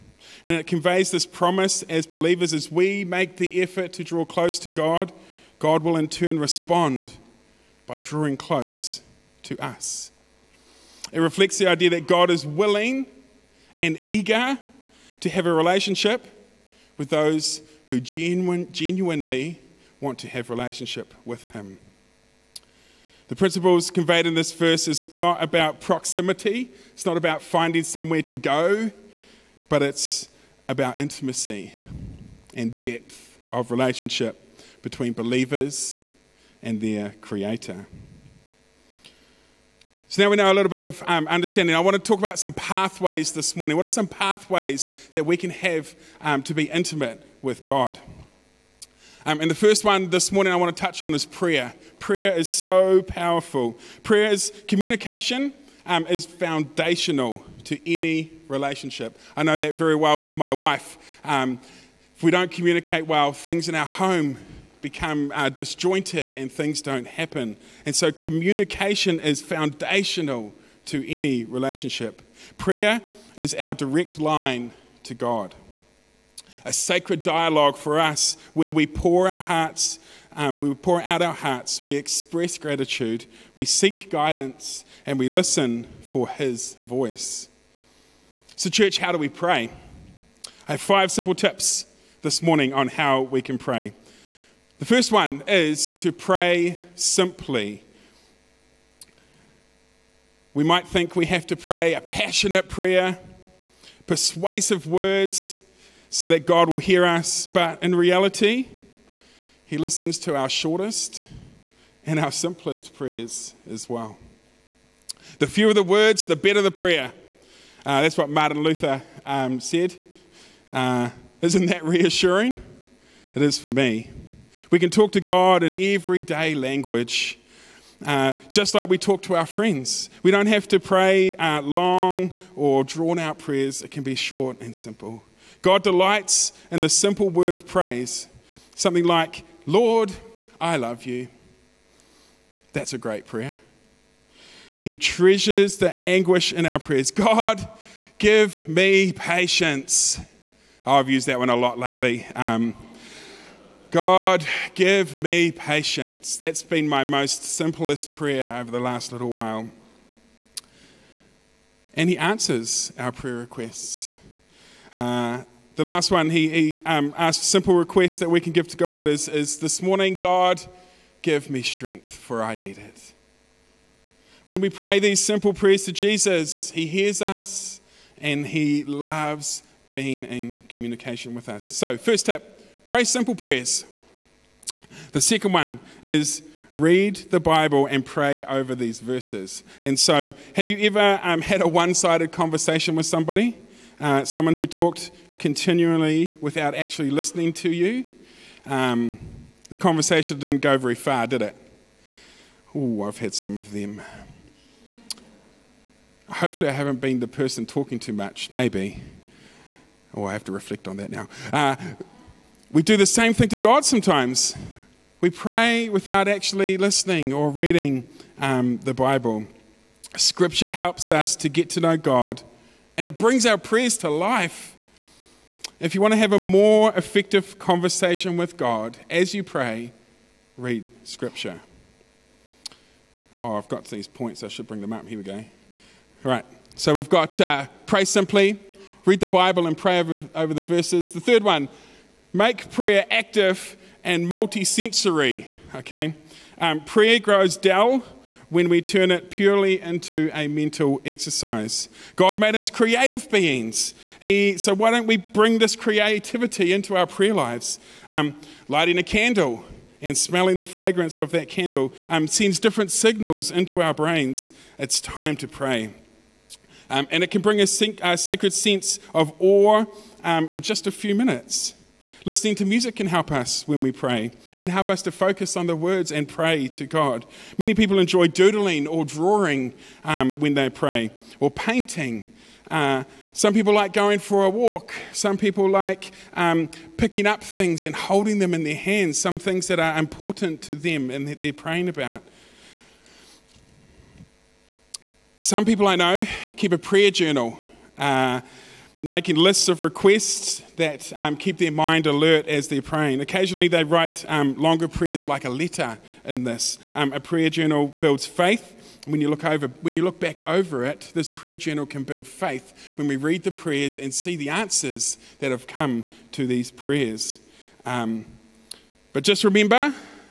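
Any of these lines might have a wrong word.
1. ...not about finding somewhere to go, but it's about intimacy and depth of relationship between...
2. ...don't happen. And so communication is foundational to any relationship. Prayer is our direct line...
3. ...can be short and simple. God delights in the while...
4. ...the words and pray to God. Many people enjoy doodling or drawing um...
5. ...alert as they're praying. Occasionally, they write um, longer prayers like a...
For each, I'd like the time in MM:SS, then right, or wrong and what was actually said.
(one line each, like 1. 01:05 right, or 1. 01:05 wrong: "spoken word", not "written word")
1. 00:27 right
2. 01:06 right
3. 02:13 wrong: "simple", not "while"
4. 04:35 right
5. 05:02 right.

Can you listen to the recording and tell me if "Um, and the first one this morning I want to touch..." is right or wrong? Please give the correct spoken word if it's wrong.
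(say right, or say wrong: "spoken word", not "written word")
right.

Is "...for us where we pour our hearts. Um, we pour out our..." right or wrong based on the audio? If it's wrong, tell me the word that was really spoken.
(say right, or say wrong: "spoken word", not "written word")
right.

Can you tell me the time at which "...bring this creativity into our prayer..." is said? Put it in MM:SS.
04:15.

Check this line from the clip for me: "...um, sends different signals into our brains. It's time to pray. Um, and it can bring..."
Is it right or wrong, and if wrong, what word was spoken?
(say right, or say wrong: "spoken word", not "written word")
right.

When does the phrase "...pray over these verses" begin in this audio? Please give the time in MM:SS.
03:08.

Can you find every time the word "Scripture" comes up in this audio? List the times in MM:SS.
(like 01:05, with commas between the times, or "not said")
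03:40, 03:51.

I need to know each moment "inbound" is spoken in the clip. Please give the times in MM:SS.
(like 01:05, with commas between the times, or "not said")
not said.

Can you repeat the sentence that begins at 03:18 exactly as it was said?
Um, the conversation didn't go very far, did it?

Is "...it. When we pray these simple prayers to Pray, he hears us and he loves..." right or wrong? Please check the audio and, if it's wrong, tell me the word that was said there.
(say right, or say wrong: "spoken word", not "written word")
wrong: "Jesus", not "Pray".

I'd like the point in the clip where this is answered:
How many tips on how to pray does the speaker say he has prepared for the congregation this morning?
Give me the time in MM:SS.
01:30.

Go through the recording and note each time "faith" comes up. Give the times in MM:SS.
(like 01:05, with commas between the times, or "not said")
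05:08, 05:12.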